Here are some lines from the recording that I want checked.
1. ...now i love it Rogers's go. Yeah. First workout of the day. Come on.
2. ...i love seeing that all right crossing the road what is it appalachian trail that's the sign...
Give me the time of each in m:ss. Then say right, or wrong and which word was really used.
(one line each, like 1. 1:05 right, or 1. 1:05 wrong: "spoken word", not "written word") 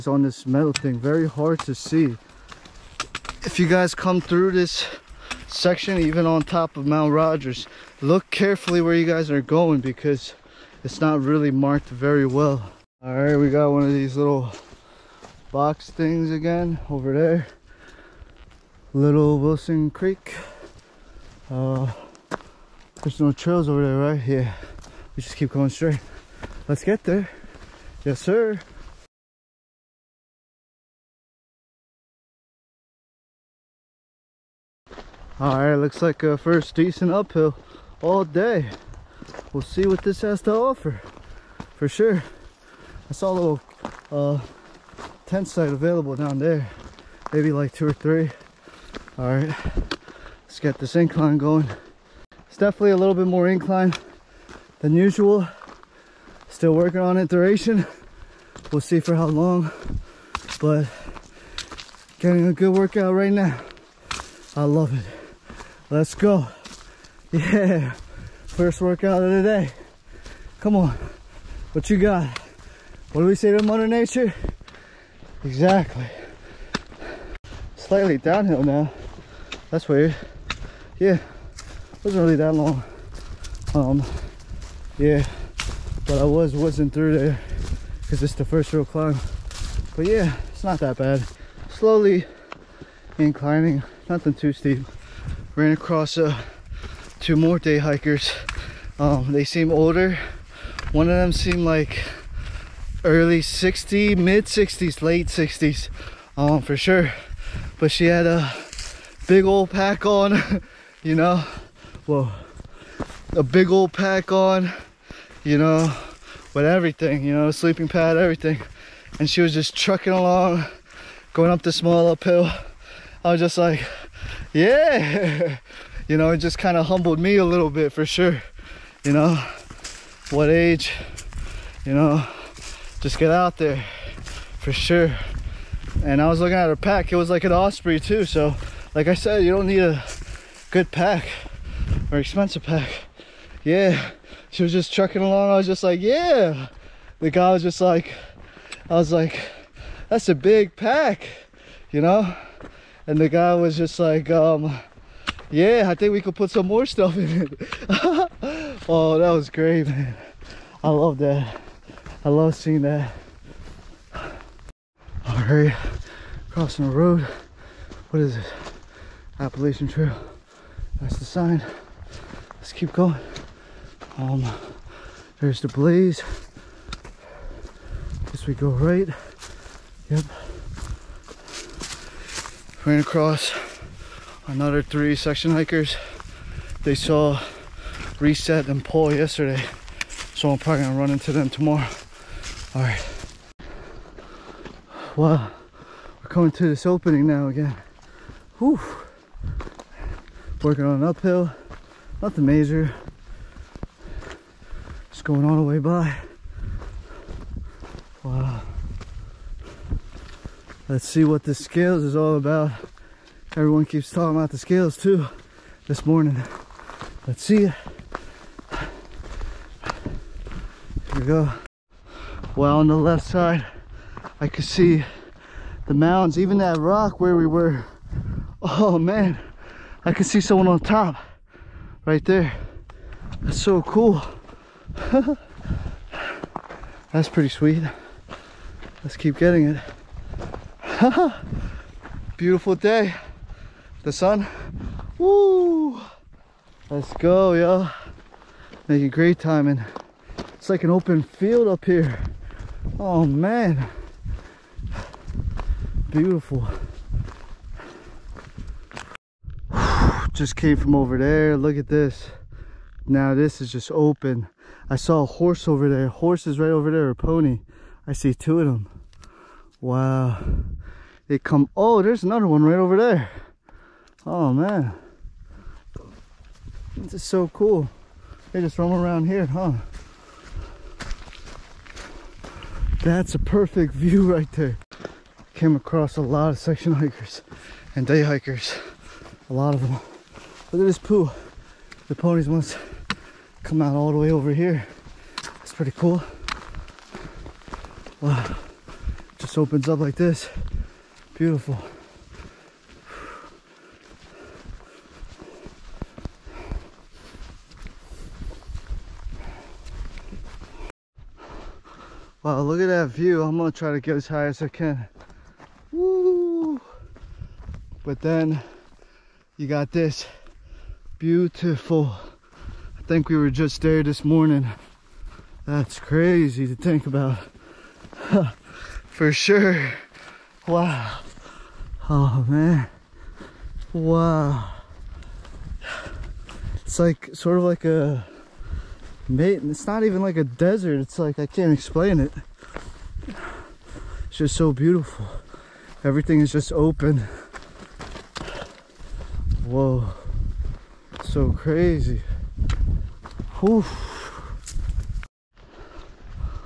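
1. 1:03 wrong: "Let", not "Rogers"
2. 2:42 right.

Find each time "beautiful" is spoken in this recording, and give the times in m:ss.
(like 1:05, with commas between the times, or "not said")
4:02, 4:16, 5:01, 5:21, 5:44.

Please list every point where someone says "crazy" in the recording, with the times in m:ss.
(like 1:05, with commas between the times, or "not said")
5:25, 5:51.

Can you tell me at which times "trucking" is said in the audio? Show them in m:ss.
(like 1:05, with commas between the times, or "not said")
1:59, 2:24.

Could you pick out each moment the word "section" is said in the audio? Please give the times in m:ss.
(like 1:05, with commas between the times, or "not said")
0:05, 3:05, 4:46.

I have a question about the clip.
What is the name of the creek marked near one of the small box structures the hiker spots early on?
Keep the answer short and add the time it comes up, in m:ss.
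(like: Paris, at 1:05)
Little Wilson Creek, at 0:18.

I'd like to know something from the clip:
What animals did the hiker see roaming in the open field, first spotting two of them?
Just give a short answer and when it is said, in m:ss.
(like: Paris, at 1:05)
Ponies, at 4:27.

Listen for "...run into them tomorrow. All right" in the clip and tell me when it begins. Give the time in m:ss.
3:10.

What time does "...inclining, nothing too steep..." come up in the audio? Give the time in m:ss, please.
1:33.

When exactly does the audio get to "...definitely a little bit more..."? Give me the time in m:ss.
0:52.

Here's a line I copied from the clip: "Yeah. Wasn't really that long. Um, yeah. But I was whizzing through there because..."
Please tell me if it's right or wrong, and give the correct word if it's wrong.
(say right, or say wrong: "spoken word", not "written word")
right.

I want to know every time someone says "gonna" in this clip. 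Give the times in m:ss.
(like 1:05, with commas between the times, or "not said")
3:10, 5:13.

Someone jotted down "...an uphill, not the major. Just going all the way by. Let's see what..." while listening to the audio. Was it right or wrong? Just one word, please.
right.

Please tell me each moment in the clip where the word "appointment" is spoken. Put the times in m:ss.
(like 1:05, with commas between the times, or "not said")
not said.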